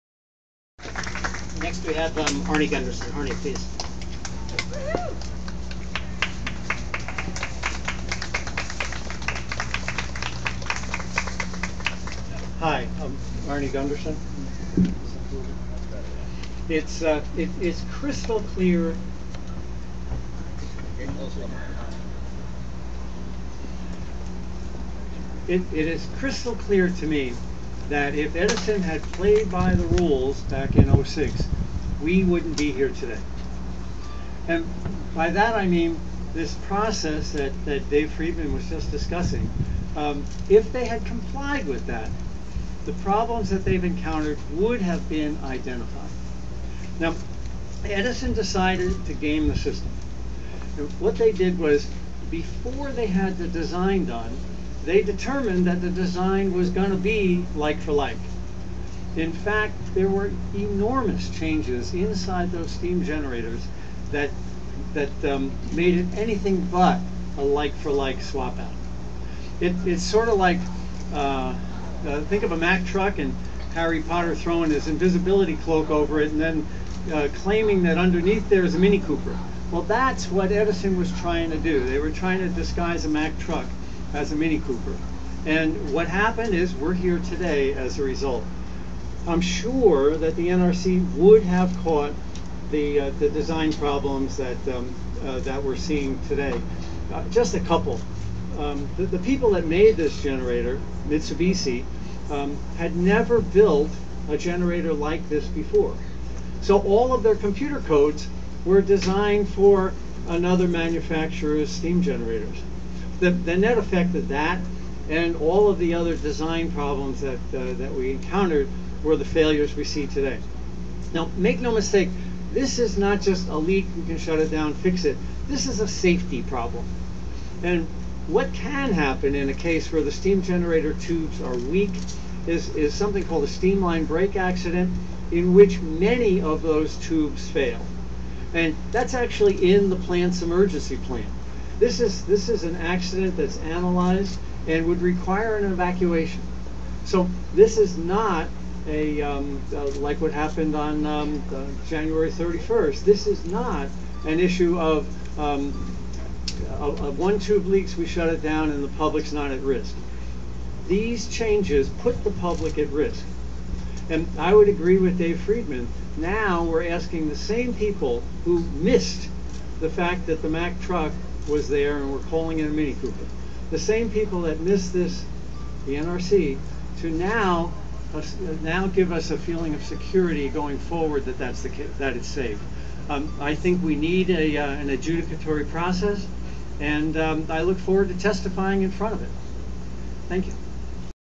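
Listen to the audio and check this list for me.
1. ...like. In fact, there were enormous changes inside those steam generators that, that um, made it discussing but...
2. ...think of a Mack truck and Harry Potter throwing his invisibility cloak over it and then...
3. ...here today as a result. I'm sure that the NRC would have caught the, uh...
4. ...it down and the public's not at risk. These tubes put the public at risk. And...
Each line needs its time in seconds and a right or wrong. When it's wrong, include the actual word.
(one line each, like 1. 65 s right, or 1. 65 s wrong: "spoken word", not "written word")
1. 57 s wrong: "anything", not "discussing"
2. 72 s right
3. 86 s right
4. 158 s wrong: "changes", not "tubes".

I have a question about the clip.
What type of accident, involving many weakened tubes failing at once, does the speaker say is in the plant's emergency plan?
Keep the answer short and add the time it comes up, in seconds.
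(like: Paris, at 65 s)
steam line break accident, at 133 s.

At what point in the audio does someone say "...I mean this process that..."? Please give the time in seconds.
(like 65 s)
35 s.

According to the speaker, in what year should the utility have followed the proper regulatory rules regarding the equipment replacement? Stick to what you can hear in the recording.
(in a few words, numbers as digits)
2006.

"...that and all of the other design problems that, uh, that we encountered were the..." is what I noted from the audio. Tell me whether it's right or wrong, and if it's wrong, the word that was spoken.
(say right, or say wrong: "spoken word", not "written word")
right.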